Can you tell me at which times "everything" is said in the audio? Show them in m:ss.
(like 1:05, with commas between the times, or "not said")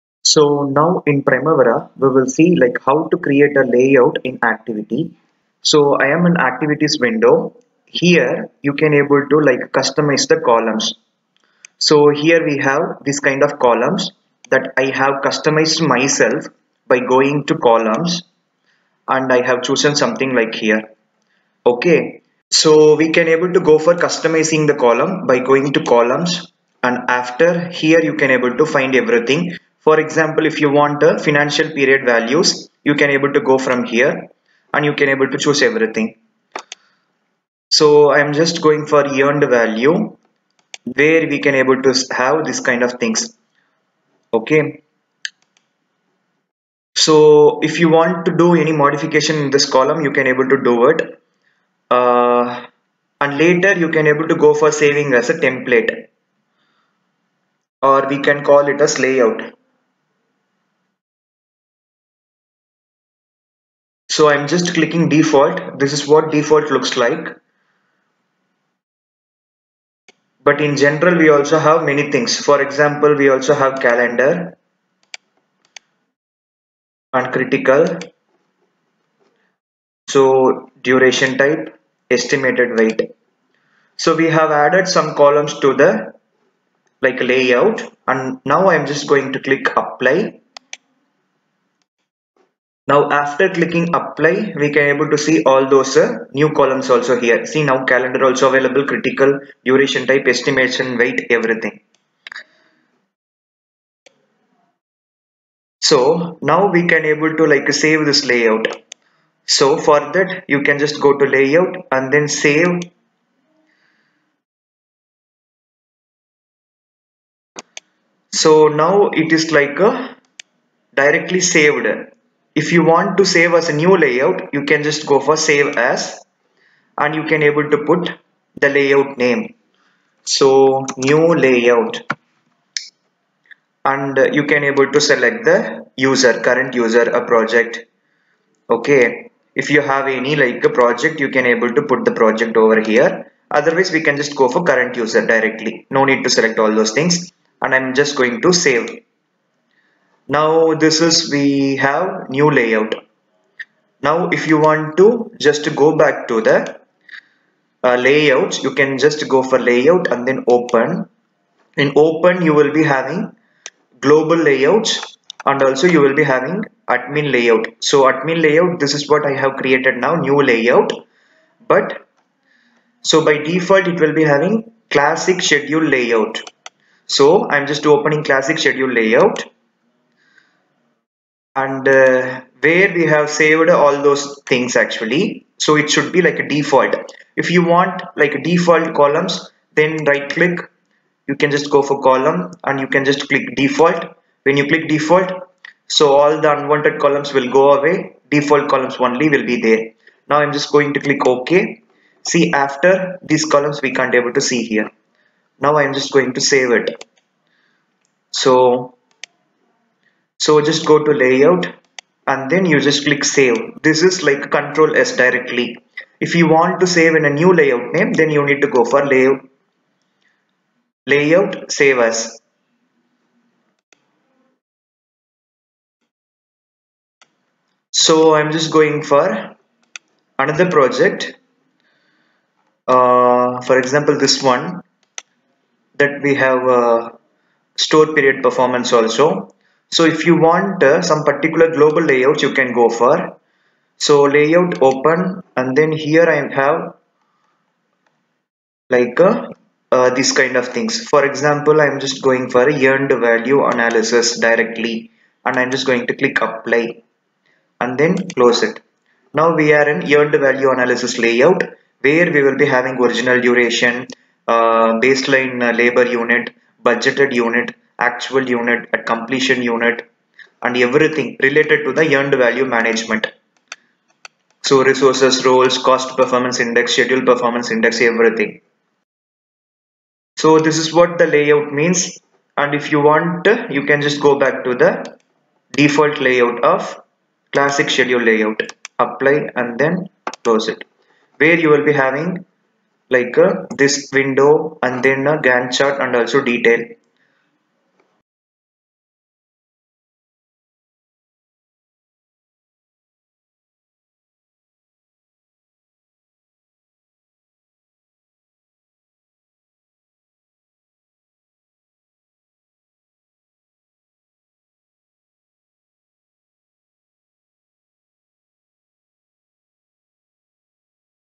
0:28, 0:35, 1:41, 4:30, 4:38.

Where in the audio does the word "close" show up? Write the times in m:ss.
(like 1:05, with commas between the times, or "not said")
4:18, 4:50.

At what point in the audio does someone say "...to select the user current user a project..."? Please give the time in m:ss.
2:14.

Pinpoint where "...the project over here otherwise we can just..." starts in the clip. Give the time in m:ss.
2:22.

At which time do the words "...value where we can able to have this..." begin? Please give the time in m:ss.
0:39.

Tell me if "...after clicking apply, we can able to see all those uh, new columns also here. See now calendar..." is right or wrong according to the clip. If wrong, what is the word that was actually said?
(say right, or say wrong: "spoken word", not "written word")
right.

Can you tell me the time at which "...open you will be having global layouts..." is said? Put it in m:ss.
2:41.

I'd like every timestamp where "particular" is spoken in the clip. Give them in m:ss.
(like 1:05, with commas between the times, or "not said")
4:01.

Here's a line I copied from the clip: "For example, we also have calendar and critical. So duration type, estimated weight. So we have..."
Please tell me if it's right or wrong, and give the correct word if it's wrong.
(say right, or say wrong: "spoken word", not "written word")
right.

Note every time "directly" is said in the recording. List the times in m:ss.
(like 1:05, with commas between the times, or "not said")
2:00, 2:25, 3:35, 4:14.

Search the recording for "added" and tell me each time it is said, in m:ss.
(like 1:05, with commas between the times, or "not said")
1:24.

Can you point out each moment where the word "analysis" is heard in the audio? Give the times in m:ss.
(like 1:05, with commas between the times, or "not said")
4:13, 4:20.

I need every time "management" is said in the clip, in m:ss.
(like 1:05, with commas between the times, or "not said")
4:32.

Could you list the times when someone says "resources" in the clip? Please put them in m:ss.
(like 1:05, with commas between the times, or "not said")
4:34.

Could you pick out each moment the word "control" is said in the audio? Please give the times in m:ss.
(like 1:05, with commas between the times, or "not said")
3:34.